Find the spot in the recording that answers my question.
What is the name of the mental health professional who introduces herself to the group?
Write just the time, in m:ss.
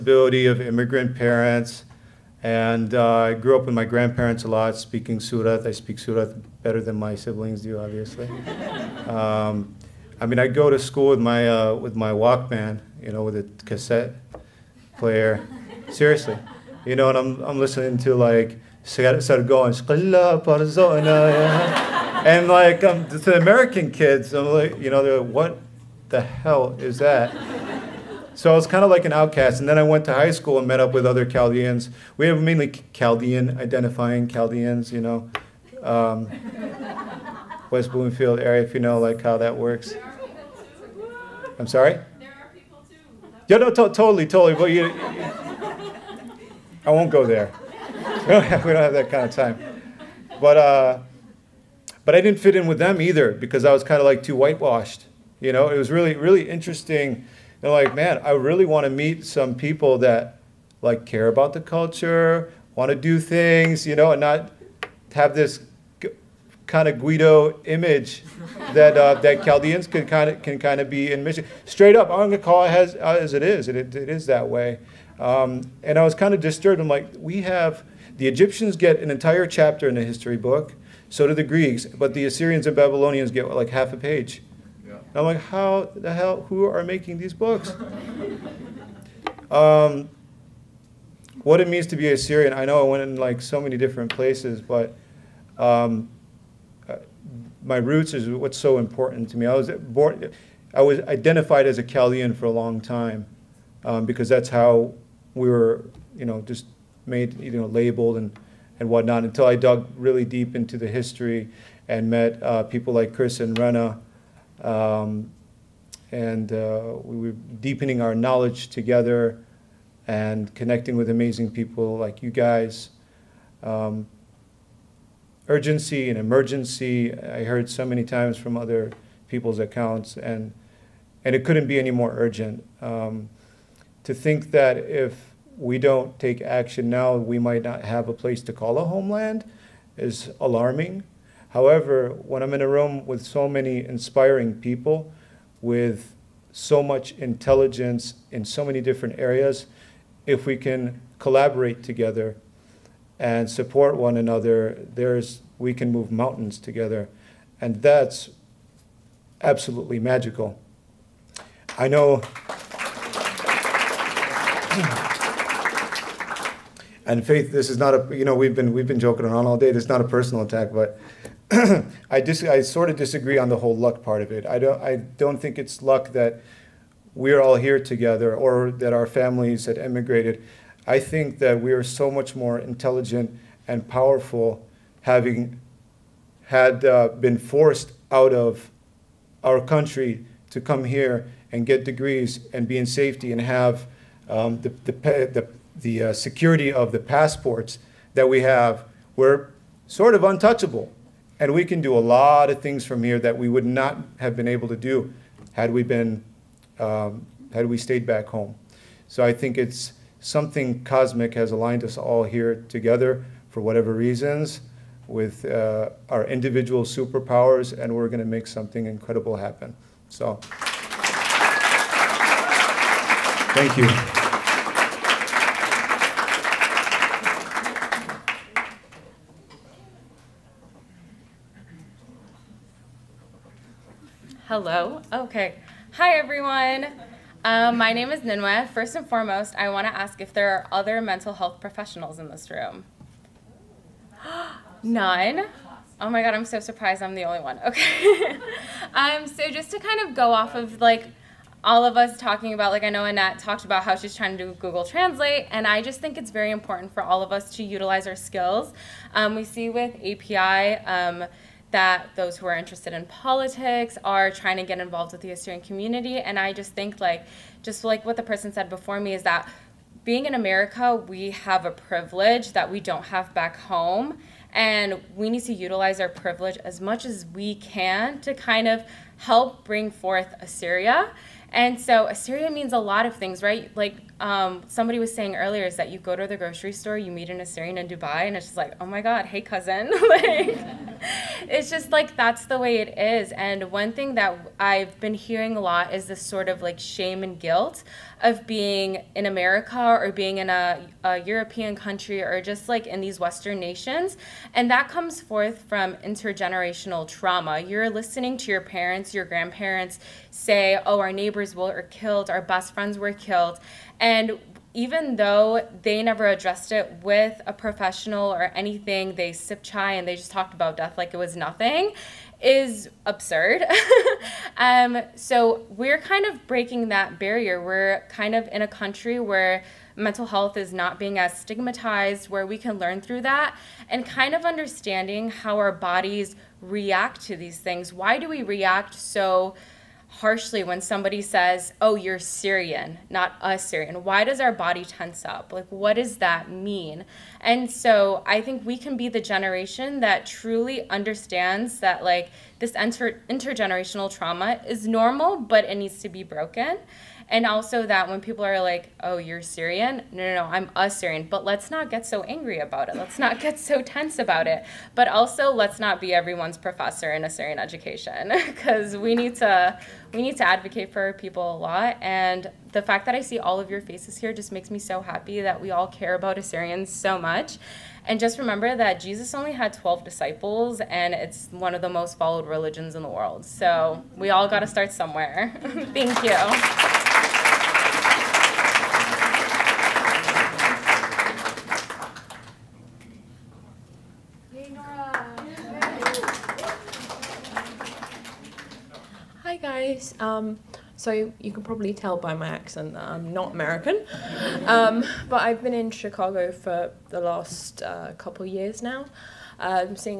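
3:58.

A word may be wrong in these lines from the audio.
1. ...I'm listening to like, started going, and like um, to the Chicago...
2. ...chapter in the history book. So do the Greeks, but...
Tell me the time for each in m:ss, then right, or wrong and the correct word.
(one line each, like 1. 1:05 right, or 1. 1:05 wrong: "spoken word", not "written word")
1. 0:17 wrong: "American", not "Chicago"
2. 1:19 right.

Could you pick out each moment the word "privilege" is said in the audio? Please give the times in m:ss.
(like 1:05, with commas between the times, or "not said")
4:31, 4:36.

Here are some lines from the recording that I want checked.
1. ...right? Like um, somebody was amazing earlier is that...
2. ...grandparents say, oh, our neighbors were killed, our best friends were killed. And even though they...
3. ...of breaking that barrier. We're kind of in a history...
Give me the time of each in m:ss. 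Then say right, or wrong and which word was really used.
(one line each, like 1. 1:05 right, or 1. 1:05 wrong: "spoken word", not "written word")
1. 4:43 wrong: "saying", not "amazing"
2. 5:09 right
3. 5:26 wrong: "country", not "history".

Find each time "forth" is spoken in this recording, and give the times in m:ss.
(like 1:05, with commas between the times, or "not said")
4:39, 5:05.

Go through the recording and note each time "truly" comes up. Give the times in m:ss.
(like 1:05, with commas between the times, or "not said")
5:50.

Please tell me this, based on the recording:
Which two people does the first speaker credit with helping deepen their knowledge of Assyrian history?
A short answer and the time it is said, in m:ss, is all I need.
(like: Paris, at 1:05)
Chris and Rena, at 1:53.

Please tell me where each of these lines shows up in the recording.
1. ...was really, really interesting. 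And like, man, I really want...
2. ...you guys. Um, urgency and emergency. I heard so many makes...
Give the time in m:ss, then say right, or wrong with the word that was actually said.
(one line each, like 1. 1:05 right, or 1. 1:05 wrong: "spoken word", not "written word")
1. 0:55 right
2. 2:02 wrong: "times", not "makes".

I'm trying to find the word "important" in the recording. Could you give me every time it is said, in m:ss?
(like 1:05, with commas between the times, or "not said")
1:38, 4:16.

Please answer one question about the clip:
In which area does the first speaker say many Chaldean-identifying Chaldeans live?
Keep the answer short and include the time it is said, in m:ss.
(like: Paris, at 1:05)
West Bloomfield, at 0:37.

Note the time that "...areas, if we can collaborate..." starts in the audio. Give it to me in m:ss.
2:29.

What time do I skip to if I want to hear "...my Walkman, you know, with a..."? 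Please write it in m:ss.
0:11.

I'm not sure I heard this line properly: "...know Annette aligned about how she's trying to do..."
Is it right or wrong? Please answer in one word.
wrong.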